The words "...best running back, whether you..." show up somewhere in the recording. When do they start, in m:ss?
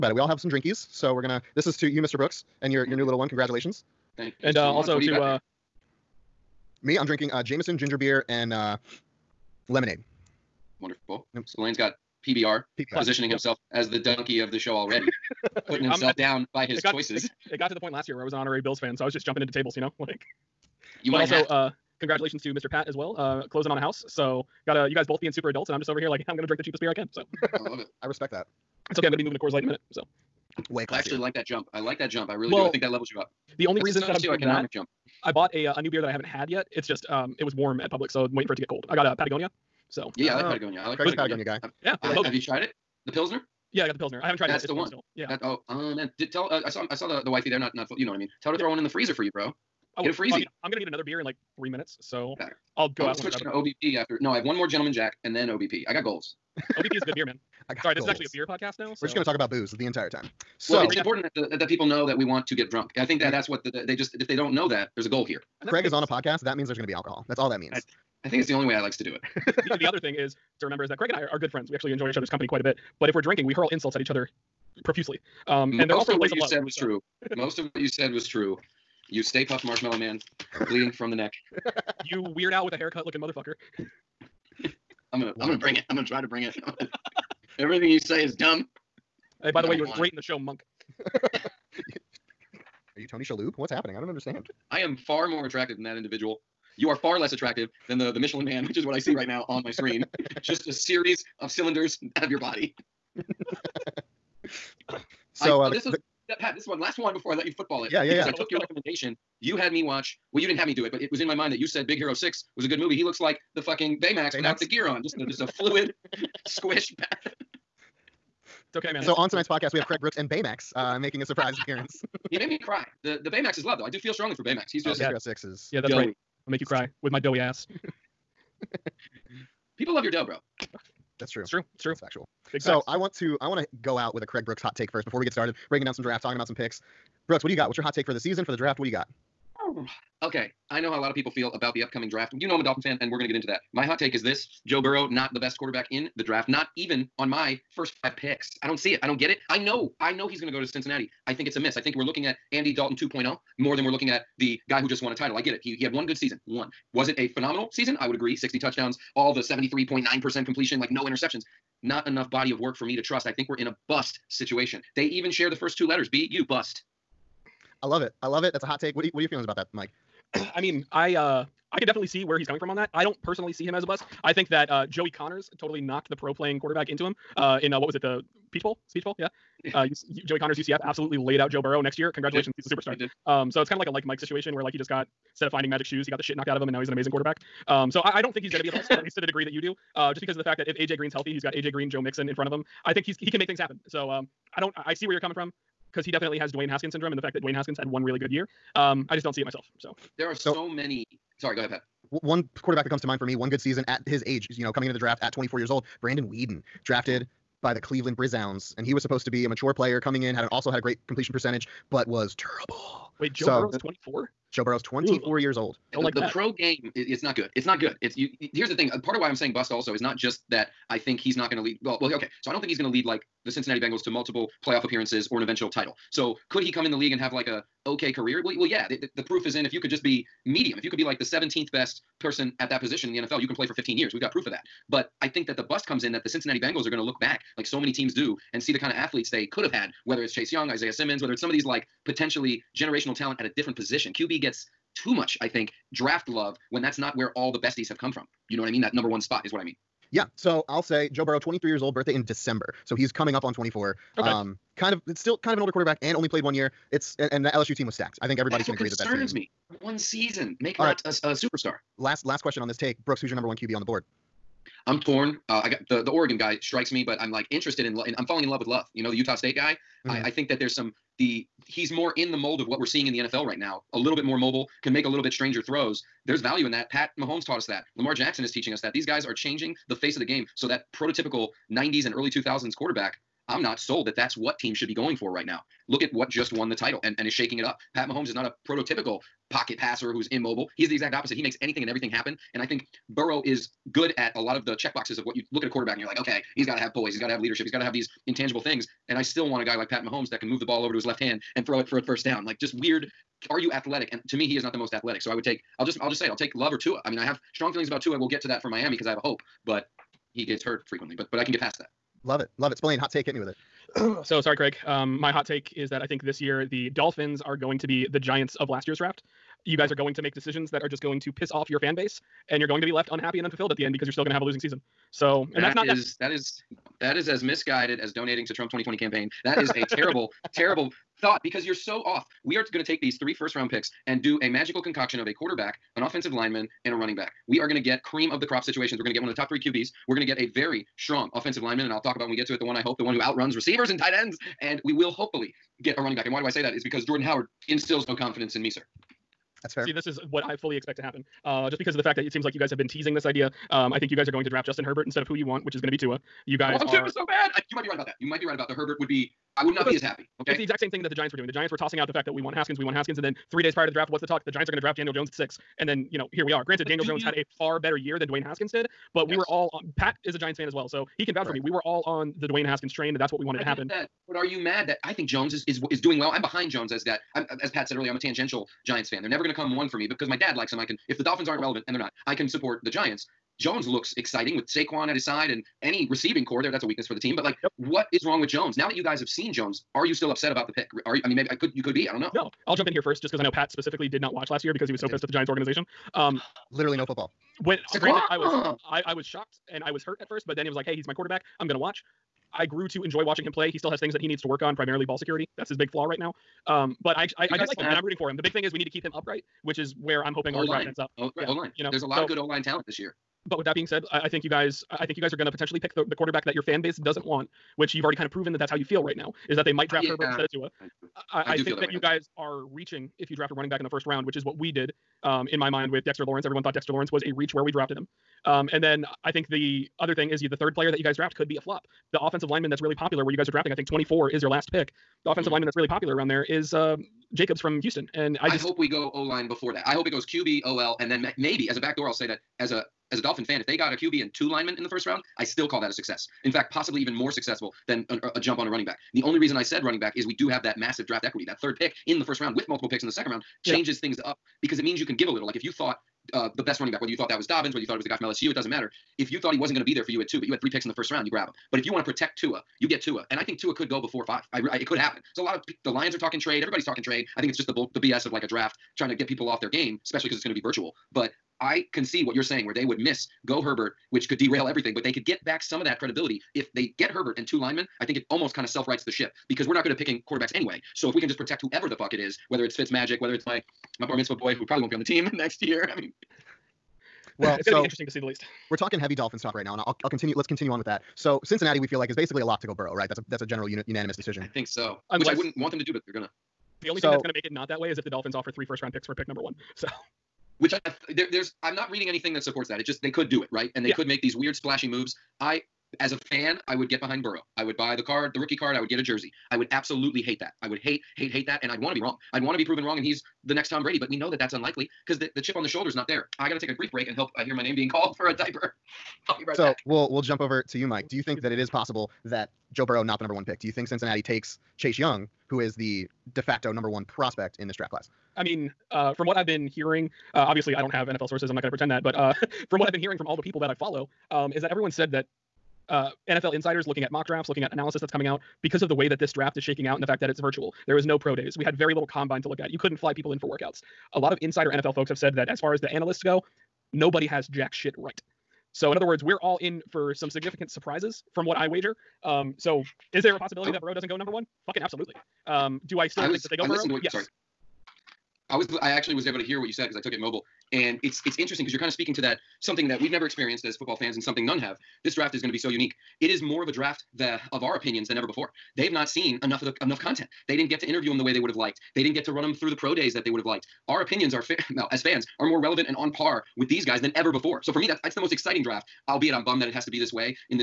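7:36.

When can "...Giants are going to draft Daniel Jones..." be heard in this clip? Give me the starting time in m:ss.
6:04.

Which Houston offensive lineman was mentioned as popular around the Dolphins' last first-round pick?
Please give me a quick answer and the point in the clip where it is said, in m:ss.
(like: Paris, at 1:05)
Jacobs, at 7:17.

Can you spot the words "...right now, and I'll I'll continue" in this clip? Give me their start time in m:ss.
8:09.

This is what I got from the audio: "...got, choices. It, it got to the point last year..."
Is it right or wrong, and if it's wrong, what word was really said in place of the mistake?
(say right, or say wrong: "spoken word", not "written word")
right.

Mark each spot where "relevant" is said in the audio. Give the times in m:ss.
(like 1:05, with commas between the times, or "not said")
6:21, 9:35.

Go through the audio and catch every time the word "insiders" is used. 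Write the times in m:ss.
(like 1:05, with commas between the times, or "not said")
8:56, 9:04.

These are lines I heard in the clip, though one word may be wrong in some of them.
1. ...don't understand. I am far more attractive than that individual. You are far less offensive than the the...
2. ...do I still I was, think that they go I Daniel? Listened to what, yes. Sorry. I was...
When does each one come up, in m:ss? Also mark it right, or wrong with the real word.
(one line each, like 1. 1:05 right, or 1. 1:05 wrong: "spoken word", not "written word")
1. 1:33 wrong: "attractive", not "offensive"
2. 9:15 wrong: "Burrow", not "Daniel".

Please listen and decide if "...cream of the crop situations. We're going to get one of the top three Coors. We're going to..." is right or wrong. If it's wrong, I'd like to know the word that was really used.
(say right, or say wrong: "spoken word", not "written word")
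wrong: "QBs", not "Coors".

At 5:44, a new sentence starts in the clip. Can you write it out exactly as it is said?
And we will hopefully get a running back.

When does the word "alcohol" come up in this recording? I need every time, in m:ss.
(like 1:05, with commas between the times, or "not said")
1:06.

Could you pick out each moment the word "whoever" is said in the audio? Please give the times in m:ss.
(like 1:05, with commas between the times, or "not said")
8:01.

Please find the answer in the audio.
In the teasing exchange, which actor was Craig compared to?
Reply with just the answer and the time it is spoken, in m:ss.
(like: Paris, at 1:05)
Monk, at 1:29.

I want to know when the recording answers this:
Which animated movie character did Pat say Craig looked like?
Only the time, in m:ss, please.
1:51.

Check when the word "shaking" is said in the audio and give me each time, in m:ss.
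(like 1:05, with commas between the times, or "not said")
4:47, 8:59.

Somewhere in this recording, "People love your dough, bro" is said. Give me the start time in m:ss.
2:09.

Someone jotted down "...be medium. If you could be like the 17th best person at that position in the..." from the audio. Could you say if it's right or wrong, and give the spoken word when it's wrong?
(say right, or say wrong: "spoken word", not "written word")
right.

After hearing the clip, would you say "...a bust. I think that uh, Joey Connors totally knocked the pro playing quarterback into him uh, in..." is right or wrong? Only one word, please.
right.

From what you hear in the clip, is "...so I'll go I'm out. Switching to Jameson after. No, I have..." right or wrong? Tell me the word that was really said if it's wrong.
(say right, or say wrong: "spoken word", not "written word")
wrong: "OBP", not "Jameson".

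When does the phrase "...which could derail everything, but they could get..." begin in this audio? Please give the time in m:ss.
7:54.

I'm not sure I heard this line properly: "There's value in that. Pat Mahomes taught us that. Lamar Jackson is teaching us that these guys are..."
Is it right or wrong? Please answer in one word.
right.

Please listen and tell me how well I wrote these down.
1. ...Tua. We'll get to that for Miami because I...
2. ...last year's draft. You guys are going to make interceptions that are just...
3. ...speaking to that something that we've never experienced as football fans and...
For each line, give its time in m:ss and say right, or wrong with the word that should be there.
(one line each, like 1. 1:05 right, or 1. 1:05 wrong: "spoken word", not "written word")
1. 5:08 right
2. 5:18 wrong: "decisions", not "interceptions"
3. 9:21 right.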